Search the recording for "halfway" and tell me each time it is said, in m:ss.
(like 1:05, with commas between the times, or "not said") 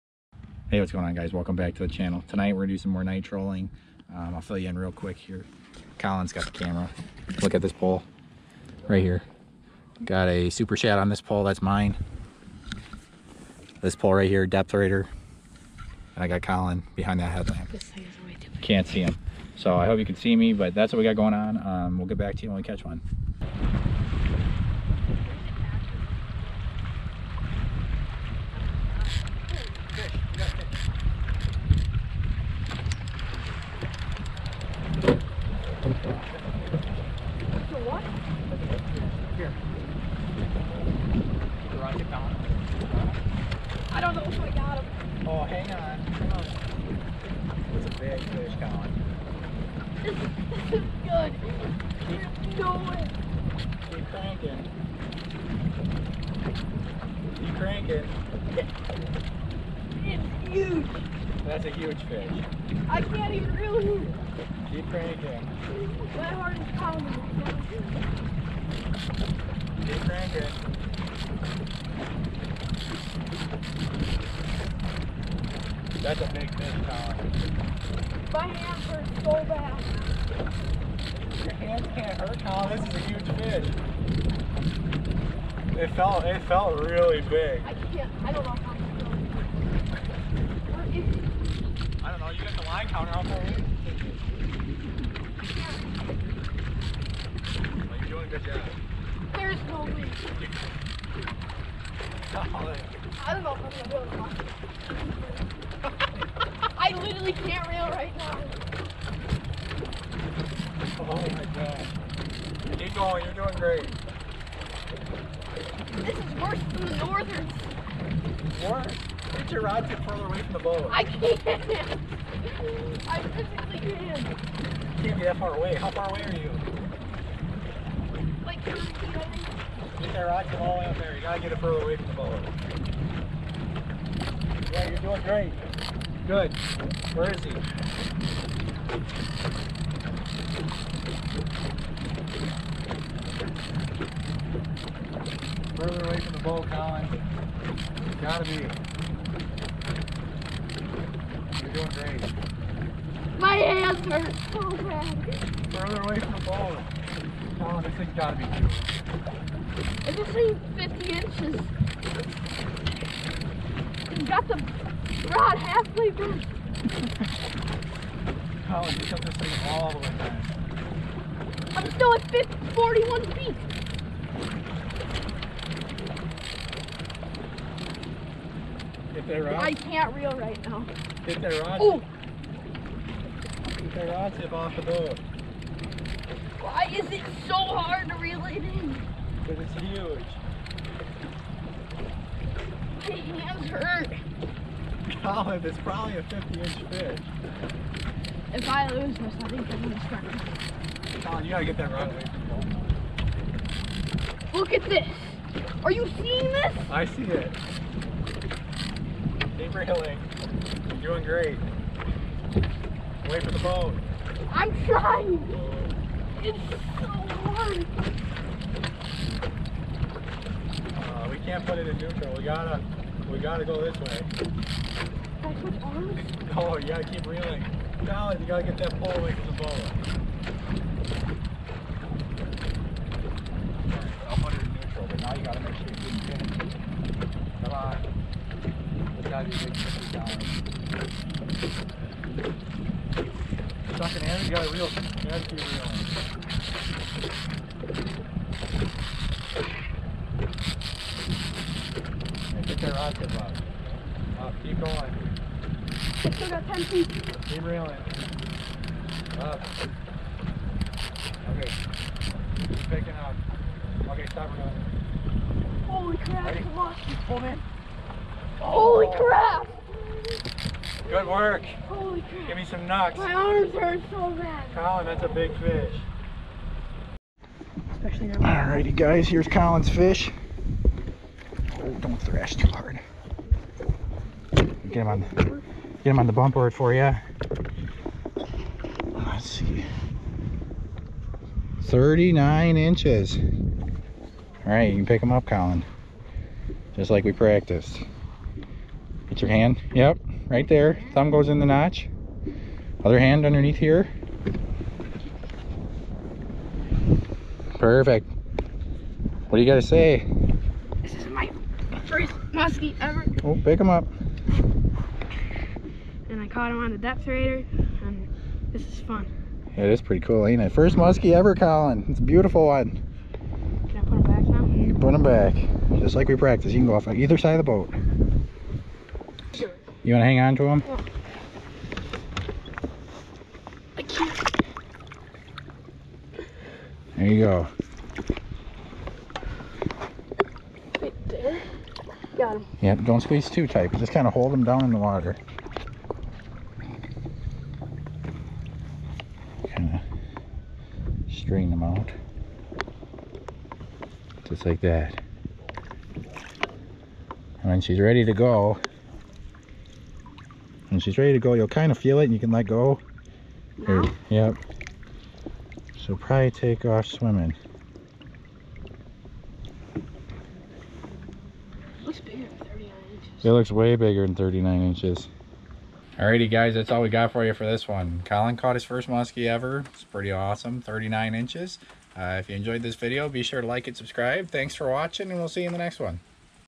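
2:45.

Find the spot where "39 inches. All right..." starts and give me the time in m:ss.
4:51.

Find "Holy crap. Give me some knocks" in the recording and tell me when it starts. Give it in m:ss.
4:31.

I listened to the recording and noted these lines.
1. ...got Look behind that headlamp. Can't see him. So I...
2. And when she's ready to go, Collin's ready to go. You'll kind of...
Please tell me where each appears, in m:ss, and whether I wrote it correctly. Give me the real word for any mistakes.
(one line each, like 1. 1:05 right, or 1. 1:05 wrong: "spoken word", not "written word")
1. 0:16 wrong: "Collin", not "Look"
2. 5:56 wrong: "She", not "Collin".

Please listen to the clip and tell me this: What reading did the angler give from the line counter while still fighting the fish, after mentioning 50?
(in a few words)
41 feet.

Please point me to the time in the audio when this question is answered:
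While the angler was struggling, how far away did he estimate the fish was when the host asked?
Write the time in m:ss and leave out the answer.
2:08.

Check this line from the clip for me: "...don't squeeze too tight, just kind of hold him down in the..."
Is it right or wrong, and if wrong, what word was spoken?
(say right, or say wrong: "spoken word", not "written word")
right.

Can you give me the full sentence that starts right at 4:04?
You got a real nasty reel.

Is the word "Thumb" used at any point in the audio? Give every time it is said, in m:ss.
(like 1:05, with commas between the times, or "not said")
5:01.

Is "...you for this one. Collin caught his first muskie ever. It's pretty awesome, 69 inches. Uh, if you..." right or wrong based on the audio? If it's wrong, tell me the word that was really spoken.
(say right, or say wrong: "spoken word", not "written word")
wrong: "39", not "69".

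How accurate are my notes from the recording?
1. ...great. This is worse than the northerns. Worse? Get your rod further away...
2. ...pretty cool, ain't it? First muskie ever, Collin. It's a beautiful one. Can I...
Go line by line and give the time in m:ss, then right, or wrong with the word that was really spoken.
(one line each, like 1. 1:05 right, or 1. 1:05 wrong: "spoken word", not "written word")
1. 1:53 right
2. 5:20 right.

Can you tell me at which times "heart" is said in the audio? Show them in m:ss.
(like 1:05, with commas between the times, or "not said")
1:06.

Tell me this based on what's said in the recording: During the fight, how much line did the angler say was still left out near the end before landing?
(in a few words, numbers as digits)
10 feet.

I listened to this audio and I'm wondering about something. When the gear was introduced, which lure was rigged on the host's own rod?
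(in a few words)
Super shad.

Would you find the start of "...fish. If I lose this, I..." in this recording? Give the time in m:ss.
3:16.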